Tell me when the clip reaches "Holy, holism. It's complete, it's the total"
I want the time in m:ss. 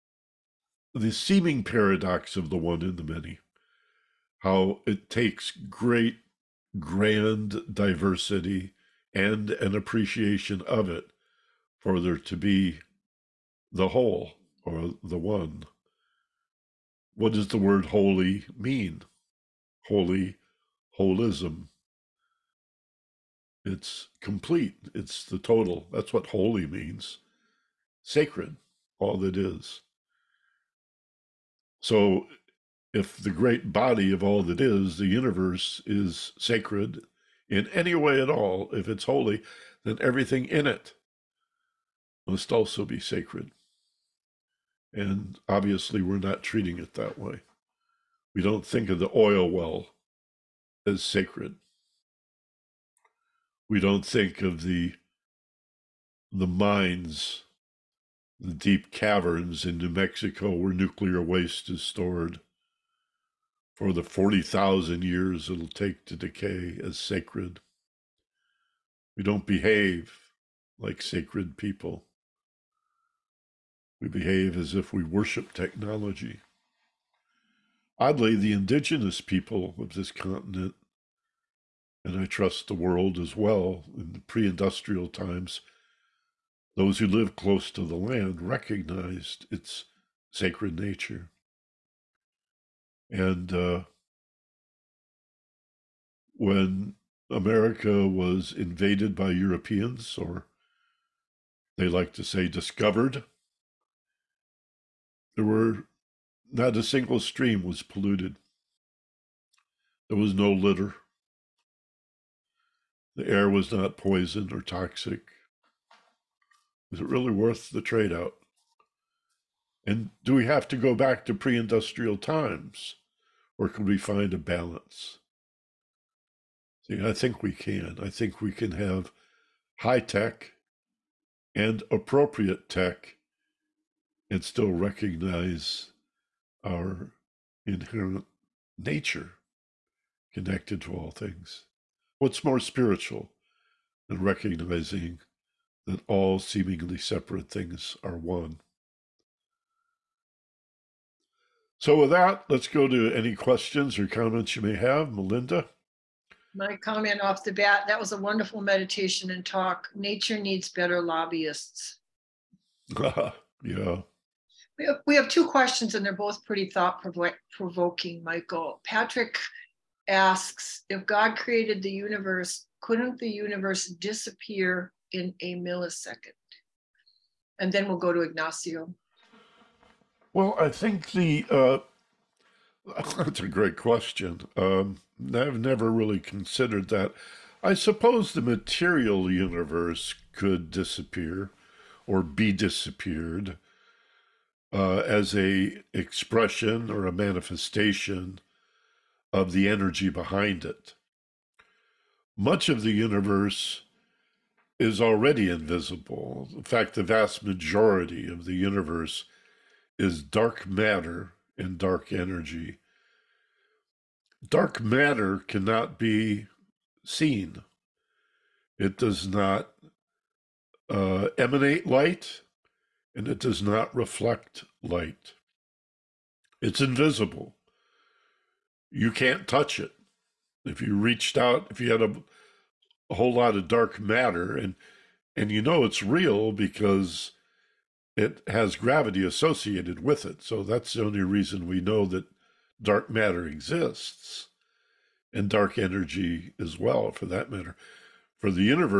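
0:19.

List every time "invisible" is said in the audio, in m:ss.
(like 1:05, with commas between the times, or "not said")
3:25, 3:46.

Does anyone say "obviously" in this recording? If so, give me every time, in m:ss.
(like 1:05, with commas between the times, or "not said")
0:45.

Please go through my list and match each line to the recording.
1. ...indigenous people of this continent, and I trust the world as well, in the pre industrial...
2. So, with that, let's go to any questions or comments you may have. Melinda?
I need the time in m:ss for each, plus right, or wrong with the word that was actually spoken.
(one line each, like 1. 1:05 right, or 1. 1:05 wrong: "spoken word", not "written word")
1. 1:18 right
2. 2:31 right.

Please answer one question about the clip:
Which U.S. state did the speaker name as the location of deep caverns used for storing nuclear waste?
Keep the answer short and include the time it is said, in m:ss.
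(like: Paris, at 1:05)
New Mexico, at 0:59.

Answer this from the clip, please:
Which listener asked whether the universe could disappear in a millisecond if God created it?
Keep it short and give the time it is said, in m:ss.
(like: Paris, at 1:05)
Patrick, at 2:48.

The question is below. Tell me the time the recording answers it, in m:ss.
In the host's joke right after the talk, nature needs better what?
2:41.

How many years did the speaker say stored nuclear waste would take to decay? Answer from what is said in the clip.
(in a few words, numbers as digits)
40,000.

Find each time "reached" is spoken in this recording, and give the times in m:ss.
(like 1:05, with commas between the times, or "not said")
3:50.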